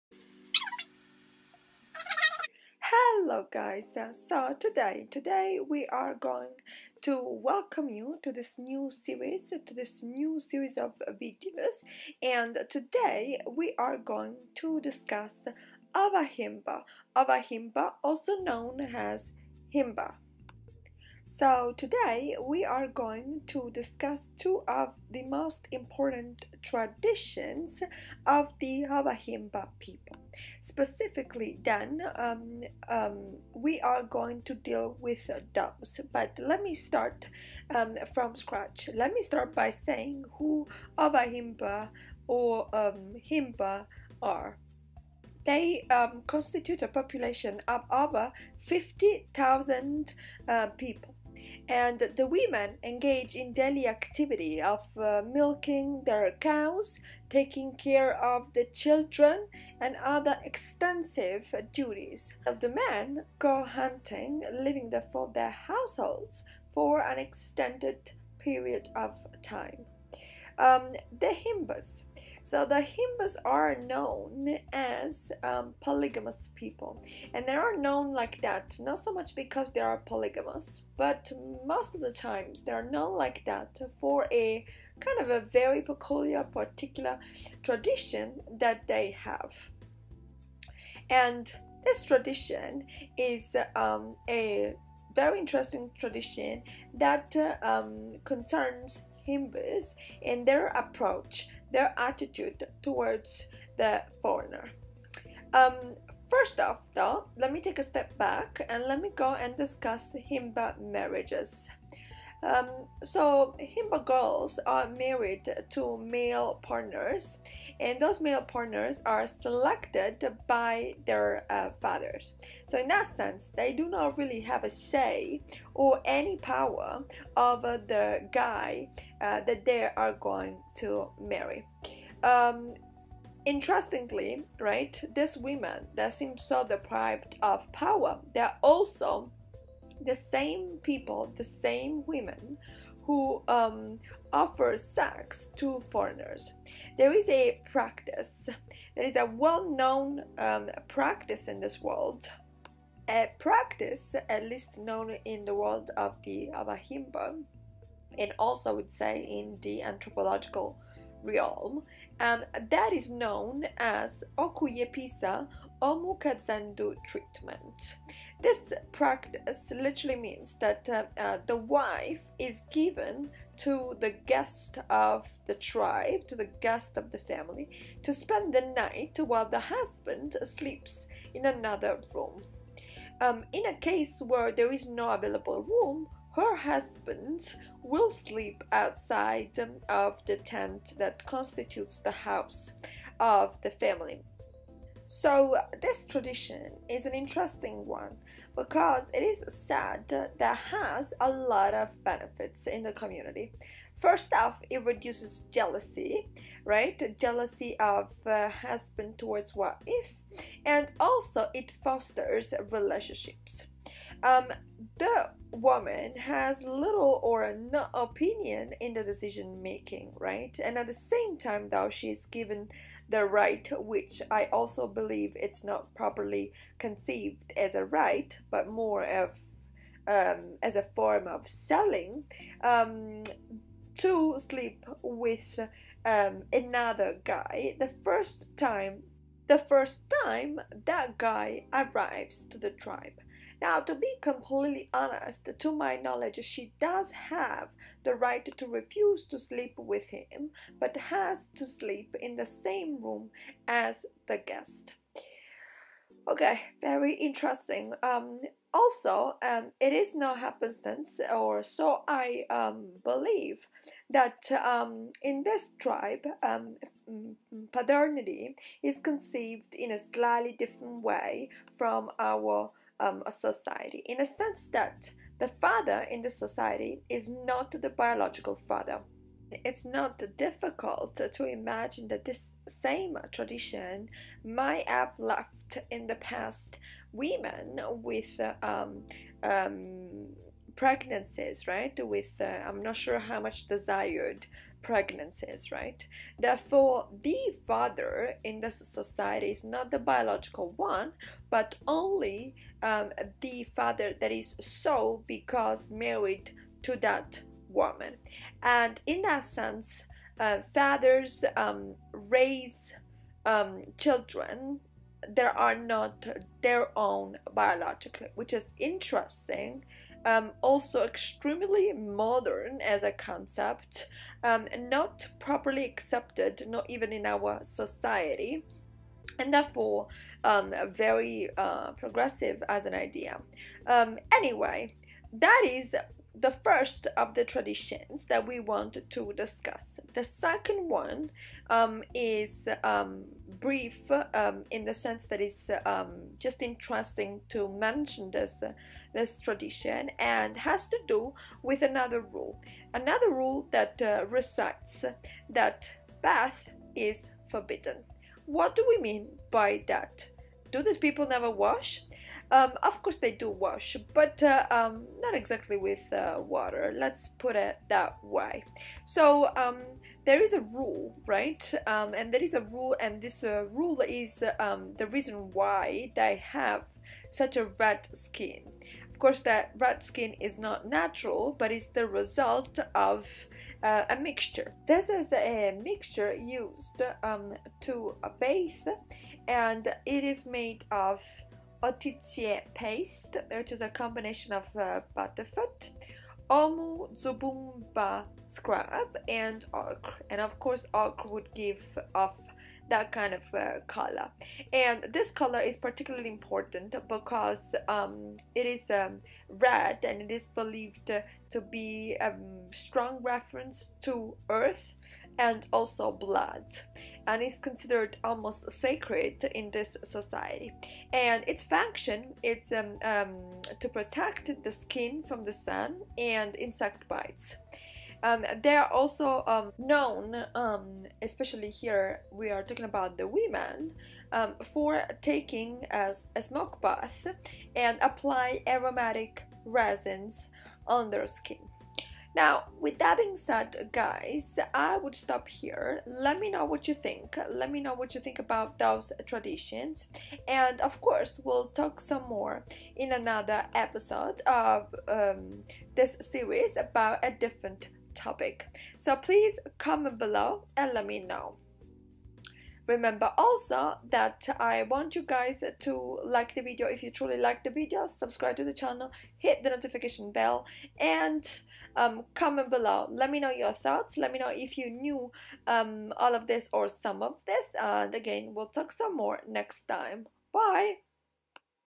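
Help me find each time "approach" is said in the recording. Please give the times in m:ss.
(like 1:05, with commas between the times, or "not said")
1:40.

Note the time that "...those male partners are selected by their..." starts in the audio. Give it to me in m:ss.
1:57.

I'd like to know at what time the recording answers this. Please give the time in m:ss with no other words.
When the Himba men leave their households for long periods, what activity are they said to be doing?
1:03.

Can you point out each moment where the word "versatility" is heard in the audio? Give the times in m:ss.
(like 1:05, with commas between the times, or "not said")
not said.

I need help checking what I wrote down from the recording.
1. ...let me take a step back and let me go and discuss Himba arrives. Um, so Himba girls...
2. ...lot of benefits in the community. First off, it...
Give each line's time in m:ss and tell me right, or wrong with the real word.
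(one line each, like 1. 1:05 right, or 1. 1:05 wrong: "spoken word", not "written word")
1. 1:47 wrong: "marriages", not "arrives"
2. 3:21 right.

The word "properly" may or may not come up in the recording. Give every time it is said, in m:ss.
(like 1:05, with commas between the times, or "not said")
3:45, 5:25.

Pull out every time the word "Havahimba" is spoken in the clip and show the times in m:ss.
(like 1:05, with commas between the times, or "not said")
0:28, 0:40.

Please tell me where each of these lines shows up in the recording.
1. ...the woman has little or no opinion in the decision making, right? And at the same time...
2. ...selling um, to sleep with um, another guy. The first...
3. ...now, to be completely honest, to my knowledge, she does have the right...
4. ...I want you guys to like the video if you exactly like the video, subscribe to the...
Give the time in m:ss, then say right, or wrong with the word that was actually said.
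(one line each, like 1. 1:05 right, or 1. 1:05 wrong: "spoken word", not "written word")
1. 3:34 right
2. 3:51 right
3. 4:03 right
4. 7:44 wrong: "truly", not "exactly".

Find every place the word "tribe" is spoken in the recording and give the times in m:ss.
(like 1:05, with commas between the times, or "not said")
2:55, 4:02, 4:25.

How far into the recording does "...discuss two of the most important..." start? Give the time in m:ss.
0:23.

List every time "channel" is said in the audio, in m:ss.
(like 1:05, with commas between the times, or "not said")
7:48.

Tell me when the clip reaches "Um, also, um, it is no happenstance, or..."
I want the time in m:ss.
4:18.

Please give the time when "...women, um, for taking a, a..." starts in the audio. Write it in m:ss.
7:13.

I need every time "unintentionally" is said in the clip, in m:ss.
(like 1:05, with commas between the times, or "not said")
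not said.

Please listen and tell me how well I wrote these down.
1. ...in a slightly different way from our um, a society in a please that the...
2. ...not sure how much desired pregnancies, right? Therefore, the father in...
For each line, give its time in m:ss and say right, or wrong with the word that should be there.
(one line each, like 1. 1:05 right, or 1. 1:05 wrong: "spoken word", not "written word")
1. 4:29 wrong: "sense", not "please"
2. 4:52 right.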